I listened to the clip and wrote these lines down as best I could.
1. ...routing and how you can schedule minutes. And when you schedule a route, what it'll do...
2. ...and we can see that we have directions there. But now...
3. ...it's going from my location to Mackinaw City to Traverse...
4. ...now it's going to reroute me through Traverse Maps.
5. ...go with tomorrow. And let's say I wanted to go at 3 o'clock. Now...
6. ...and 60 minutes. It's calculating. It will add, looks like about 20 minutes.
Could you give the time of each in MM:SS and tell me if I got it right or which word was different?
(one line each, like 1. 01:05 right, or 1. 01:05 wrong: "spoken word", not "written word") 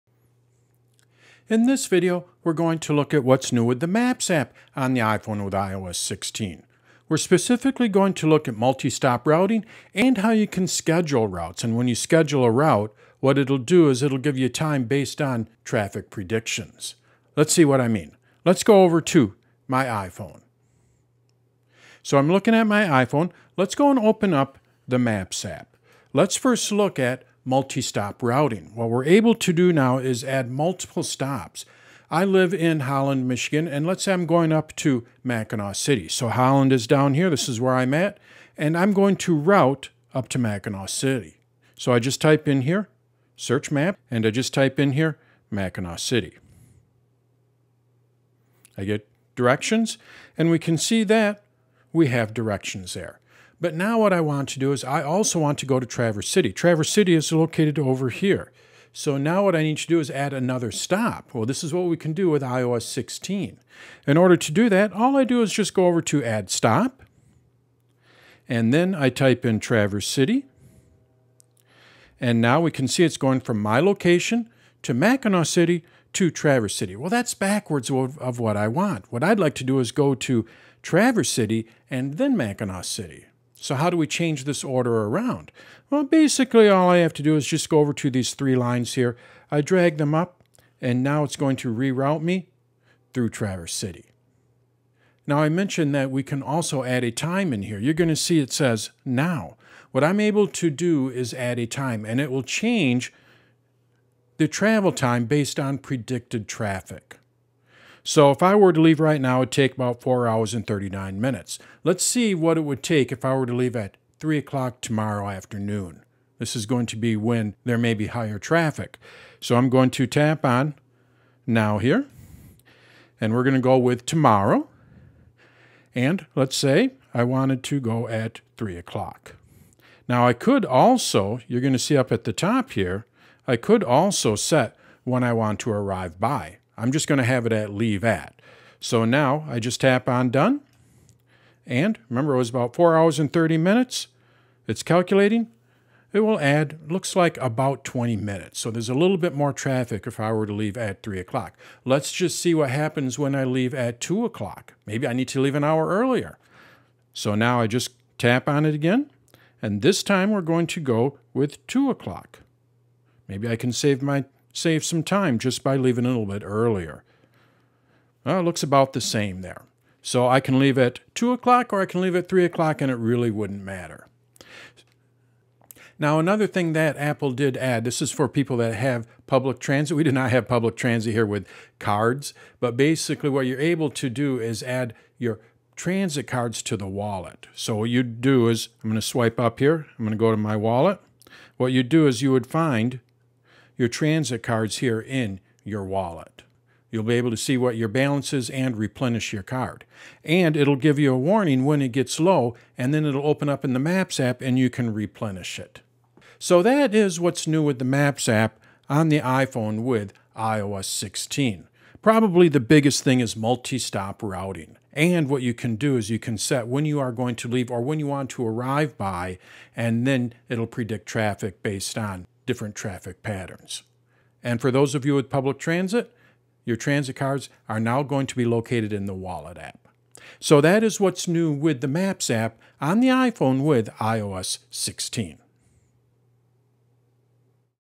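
1. 00:09 wrong: "routes", not "minutes"
2. 00:50 right
3. 01:13 right
4. 01:31 wrong: "City", not "Maps"
5. 02:03 right
6. 02:23 wrong: "30", not "60".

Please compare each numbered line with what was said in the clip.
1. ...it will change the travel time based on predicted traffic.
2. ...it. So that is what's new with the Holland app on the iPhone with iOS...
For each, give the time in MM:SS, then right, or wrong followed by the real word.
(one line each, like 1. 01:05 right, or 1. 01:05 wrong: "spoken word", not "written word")
1. 01:42 right
2. 03:25 wrong: "Maps", not "Holland".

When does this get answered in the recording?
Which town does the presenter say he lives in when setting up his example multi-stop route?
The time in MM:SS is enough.
00:32.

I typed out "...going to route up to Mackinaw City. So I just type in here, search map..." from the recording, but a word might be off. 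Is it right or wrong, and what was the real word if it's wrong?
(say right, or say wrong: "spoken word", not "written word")
right.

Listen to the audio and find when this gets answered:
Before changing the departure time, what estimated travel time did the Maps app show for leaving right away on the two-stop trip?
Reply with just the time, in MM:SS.
01:50.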